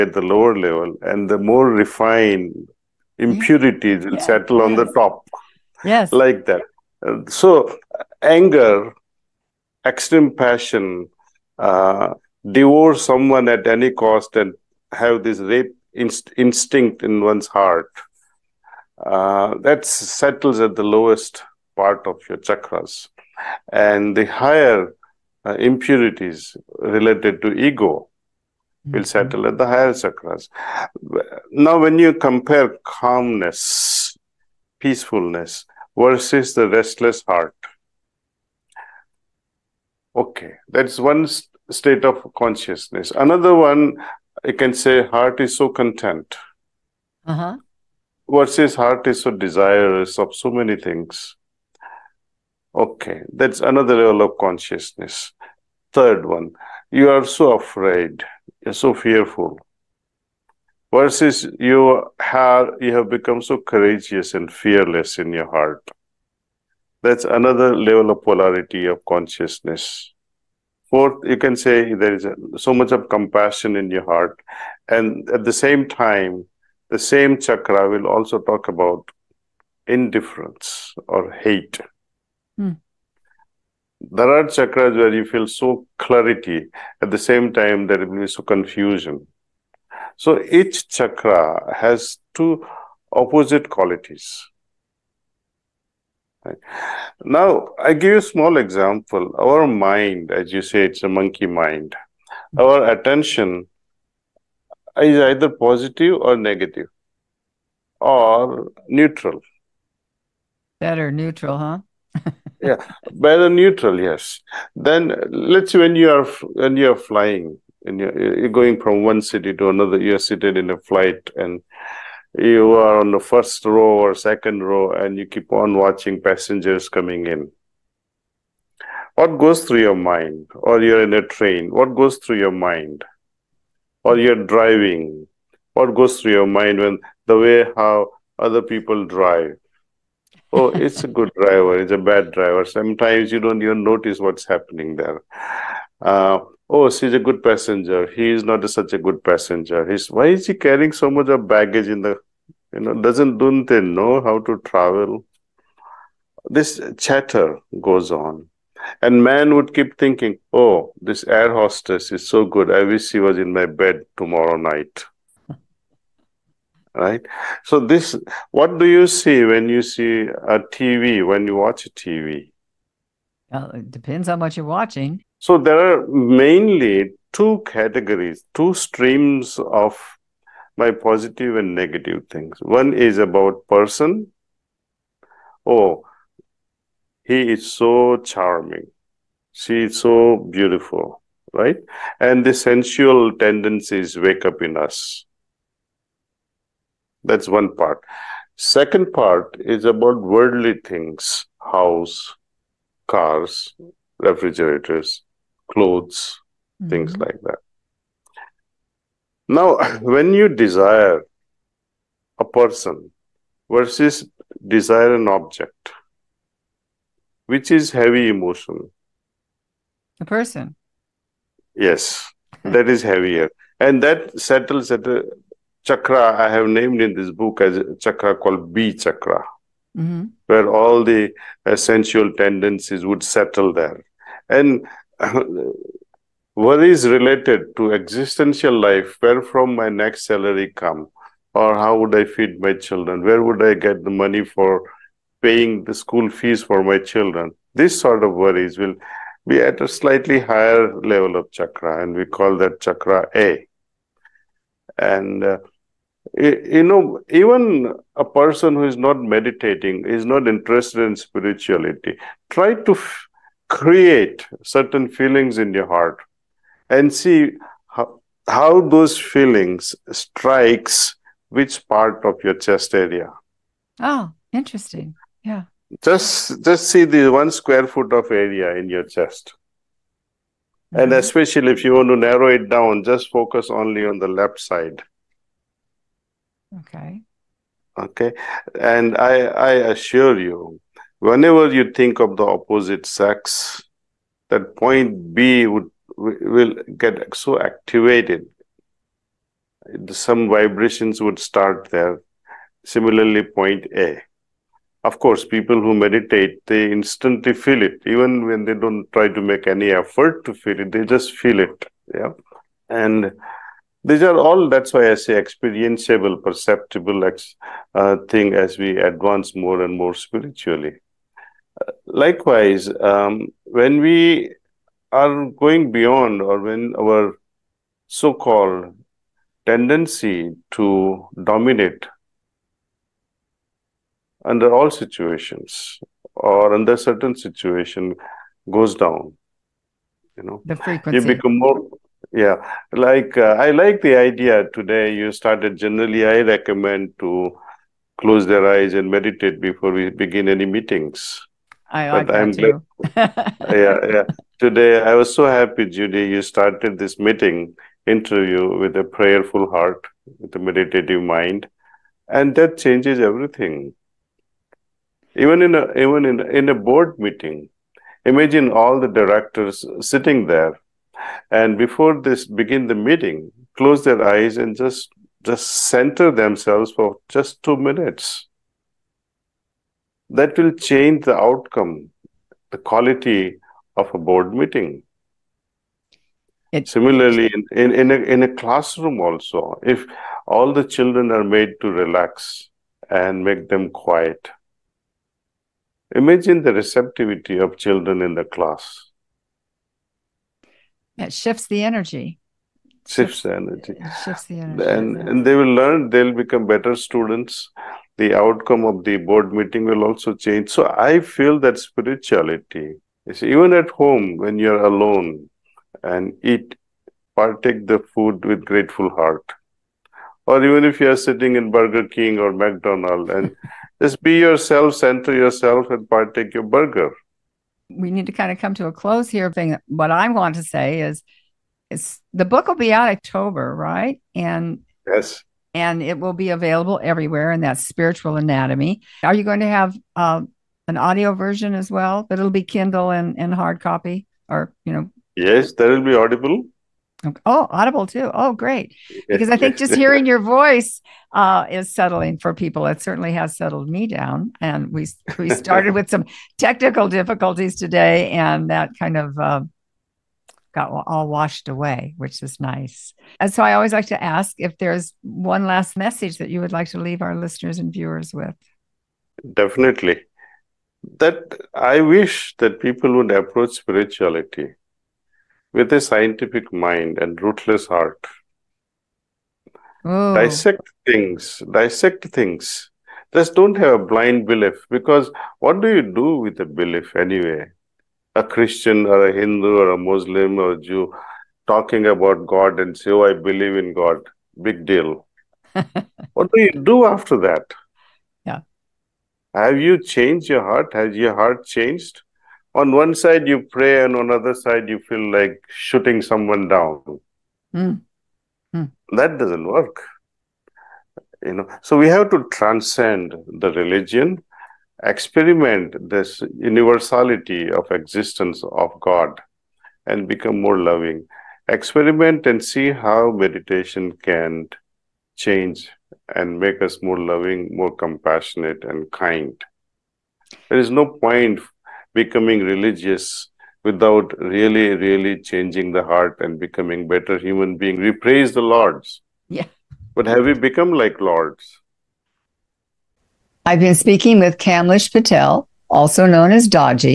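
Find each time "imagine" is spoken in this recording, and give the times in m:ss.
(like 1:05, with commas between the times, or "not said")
6:08, 6:36.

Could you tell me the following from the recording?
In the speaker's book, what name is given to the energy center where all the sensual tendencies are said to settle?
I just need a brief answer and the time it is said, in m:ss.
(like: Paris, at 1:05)
B chakra, at 3:48.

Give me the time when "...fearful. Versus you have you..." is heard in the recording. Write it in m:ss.
0:58.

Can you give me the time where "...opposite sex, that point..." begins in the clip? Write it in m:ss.
4:52.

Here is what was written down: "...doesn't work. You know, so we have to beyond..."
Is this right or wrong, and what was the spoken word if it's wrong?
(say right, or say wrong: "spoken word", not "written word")
wrong: "transcend", not "beyond".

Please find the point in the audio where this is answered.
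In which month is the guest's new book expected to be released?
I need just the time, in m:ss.
7:13.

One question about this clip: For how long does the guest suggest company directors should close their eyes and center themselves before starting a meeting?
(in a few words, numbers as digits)
2 minutes.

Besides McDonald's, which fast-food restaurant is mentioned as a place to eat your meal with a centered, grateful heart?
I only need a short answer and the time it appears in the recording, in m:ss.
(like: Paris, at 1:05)
Burger King, at 7:01.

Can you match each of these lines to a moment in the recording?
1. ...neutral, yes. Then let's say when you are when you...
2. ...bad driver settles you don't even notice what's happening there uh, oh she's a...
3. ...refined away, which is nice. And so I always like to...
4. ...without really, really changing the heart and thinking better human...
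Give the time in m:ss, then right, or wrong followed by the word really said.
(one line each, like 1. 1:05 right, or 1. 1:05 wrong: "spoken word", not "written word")
1. 1:53 right
2. 2:21 wrong: "sometimes", not "settles"
3. 7:41 wrong: "washed", not "refined"
4. 8:53 wrong: "becoming", not "thinking".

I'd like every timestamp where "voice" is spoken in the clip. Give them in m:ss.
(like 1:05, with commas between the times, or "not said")
7:30.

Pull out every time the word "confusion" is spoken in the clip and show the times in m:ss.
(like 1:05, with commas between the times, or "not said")
1:28.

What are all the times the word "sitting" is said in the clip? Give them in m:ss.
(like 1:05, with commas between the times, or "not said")
6:10, 7:01.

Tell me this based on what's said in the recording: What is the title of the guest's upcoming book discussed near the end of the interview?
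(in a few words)
Spiritual Anatomy.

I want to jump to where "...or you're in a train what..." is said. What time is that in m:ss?
2:10.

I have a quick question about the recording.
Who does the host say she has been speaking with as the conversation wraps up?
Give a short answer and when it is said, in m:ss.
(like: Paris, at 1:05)
Kamlesh Patel, at 9:04.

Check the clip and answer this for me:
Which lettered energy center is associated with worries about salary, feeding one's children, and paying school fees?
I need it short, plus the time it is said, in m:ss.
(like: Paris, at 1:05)
chakra A, at 4:12.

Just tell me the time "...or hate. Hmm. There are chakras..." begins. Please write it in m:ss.
1:21.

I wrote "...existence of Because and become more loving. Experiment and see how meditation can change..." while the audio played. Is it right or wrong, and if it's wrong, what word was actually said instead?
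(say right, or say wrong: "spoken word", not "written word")
wrong: "God", not "Because".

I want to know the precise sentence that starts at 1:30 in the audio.
So each chakra has two opposite qualities.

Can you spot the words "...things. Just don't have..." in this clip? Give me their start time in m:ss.
8:02.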